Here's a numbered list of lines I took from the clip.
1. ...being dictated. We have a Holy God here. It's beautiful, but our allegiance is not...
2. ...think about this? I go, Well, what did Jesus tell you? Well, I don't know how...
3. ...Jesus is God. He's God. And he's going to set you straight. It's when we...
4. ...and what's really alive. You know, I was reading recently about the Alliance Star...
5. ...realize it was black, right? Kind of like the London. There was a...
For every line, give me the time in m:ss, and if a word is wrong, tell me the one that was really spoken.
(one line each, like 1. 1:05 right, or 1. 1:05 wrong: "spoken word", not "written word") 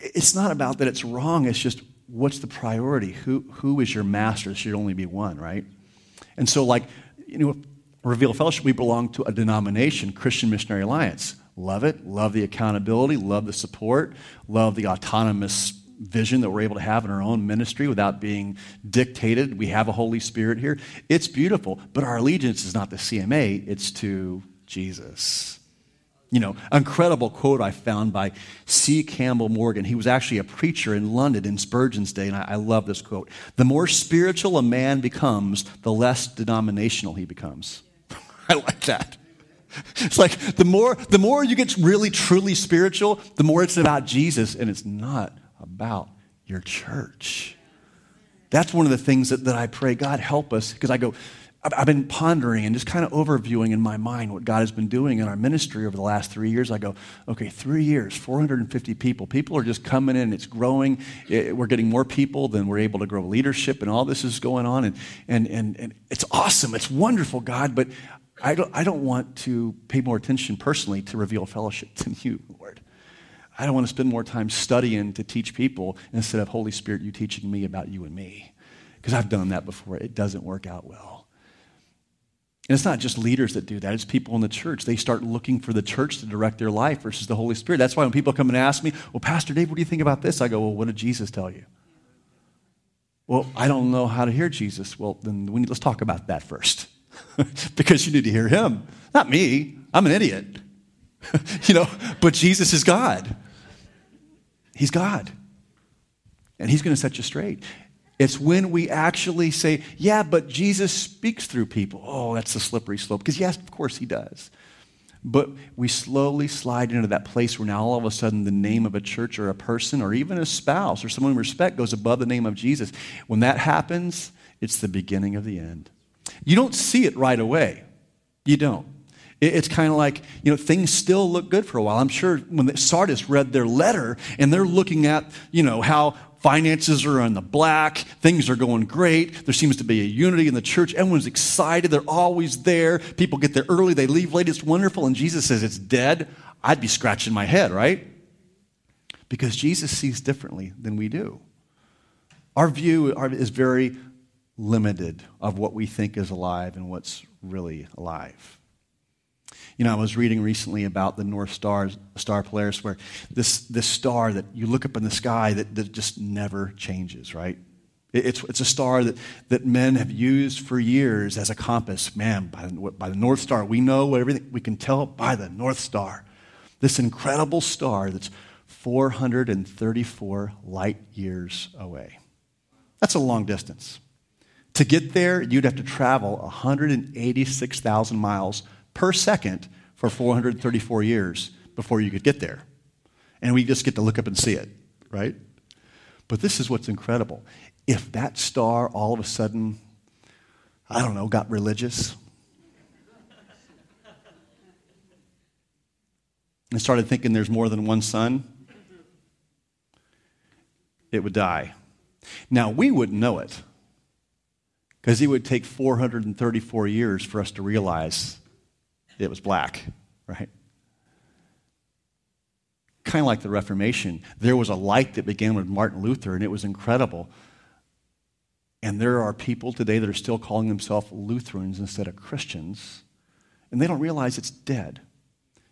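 1. 0:18 wrong: "Spirit", not "God"
2. 1:29 right
3. 1:42 right
4. 2:36 wrong: "North", not "Alliance"
5. 3:37 wrong: "Reformation", not "London".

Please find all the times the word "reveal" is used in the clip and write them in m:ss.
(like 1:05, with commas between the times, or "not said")
0:08, 1:11.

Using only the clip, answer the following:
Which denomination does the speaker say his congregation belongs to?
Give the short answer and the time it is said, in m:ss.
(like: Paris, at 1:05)
Christian Missionary Alliance, at 0:10.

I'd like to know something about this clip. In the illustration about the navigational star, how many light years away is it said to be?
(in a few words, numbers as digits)
434.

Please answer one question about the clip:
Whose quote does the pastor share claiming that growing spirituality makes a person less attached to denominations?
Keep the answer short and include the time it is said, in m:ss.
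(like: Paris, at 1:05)
G. Campbell Morgan, at 0:28.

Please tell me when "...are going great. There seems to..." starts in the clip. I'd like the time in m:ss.
2:18.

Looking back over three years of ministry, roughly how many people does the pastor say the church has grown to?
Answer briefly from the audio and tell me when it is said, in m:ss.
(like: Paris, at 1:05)
450, at 0:58.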